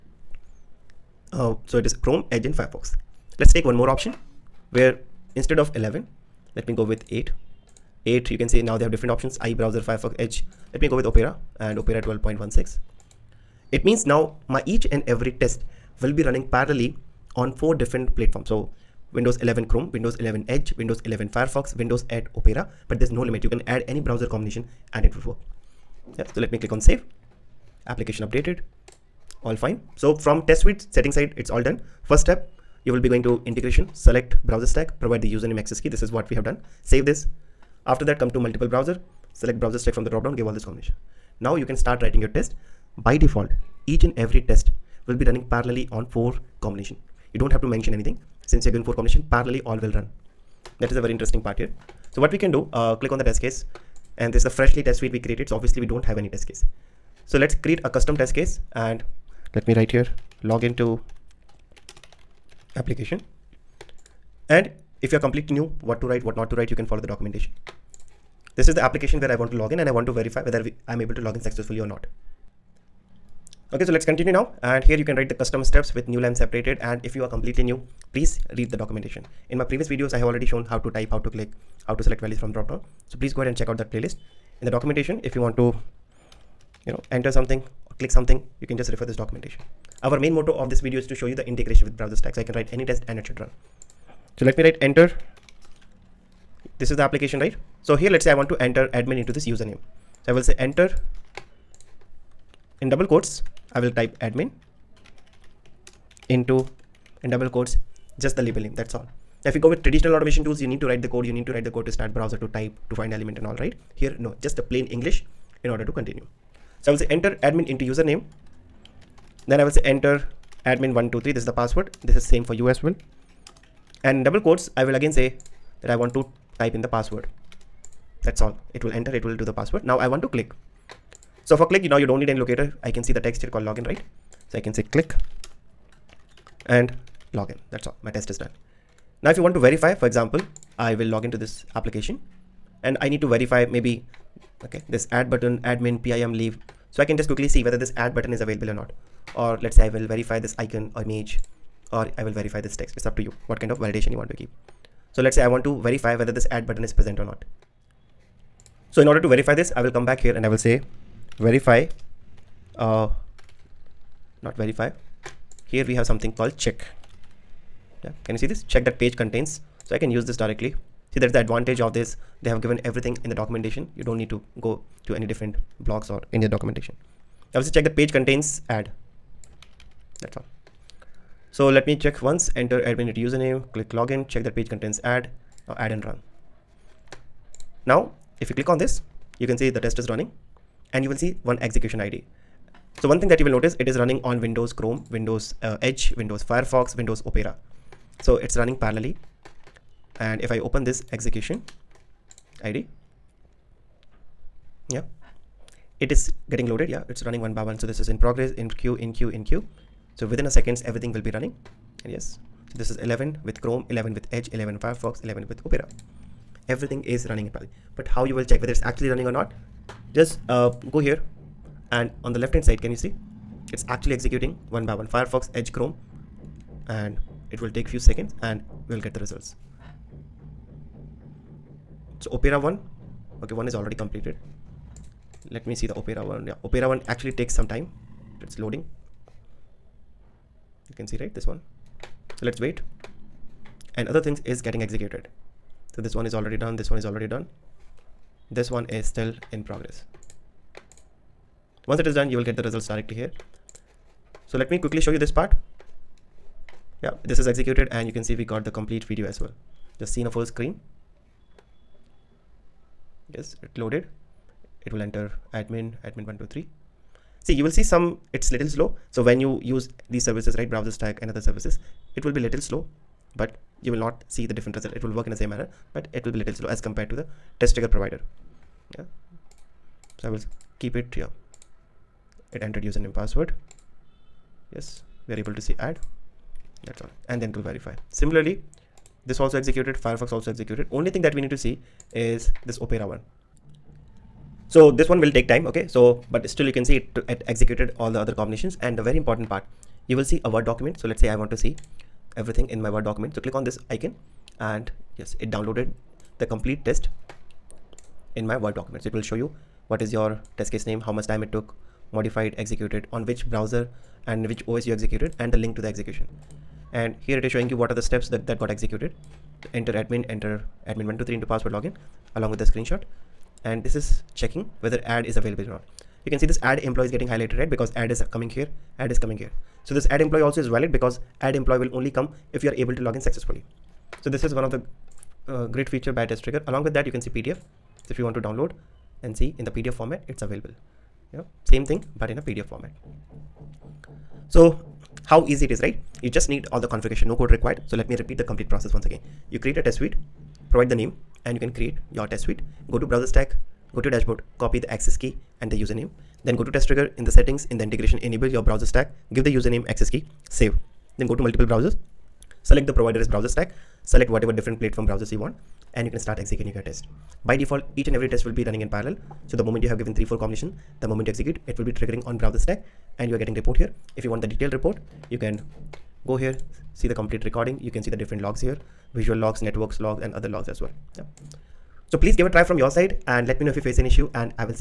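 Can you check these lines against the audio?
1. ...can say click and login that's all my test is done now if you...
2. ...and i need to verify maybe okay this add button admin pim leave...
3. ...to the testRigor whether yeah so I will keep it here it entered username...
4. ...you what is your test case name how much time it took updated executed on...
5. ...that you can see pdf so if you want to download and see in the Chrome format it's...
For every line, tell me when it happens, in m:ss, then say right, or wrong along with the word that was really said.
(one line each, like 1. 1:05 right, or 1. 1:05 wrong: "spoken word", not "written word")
1. 2:14 right
2. 2:22 right
3. 4:37 wrong: "provider", not "whether"
4. 5:09 wrong: "modified", not "updated"
5. 5:36 wrong: "PDF", not "Chrome".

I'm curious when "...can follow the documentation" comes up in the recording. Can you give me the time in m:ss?
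1:06.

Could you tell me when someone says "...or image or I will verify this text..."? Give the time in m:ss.
2:30.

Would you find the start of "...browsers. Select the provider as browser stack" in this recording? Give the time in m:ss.
6:01.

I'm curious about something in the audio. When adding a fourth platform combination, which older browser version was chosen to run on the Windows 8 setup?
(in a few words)
Opera 12.16.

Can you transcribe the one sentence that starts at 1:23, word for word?
So please go ahead and check out that playlist.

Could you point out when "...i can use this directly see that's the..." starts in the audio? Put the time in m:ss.
2:49.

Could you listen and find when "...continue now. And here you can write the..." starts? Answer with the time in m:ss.
1:14.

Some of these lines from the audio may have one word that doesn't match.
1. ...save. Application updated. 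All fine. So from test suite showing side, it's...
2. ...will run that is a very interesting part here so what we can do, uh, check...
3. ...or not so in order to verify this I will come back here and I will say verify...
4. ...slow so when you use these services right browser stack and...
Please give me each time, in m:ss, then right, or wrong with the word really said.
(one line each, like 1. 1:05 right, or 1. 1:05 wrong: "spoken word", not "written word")
1. 0:26 wrong: "setting", not "showing"
2. 0:49 wrong: "click", not "check"
3. 2:37 right
4. 4:28 right.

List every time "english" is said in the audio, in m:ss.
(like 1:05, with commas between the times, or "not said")
1:54.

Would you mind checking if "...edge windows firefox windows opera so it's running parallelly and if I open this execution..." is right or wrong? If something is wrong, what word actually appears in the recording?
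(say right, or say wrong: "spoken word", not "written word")
right.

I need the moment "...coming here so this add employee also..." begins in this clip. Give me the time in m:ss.
5:29.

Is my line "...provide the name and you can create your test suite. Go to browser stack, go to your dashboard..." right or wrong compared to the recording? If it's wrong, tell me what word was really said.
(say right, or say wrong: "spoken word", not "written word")
right.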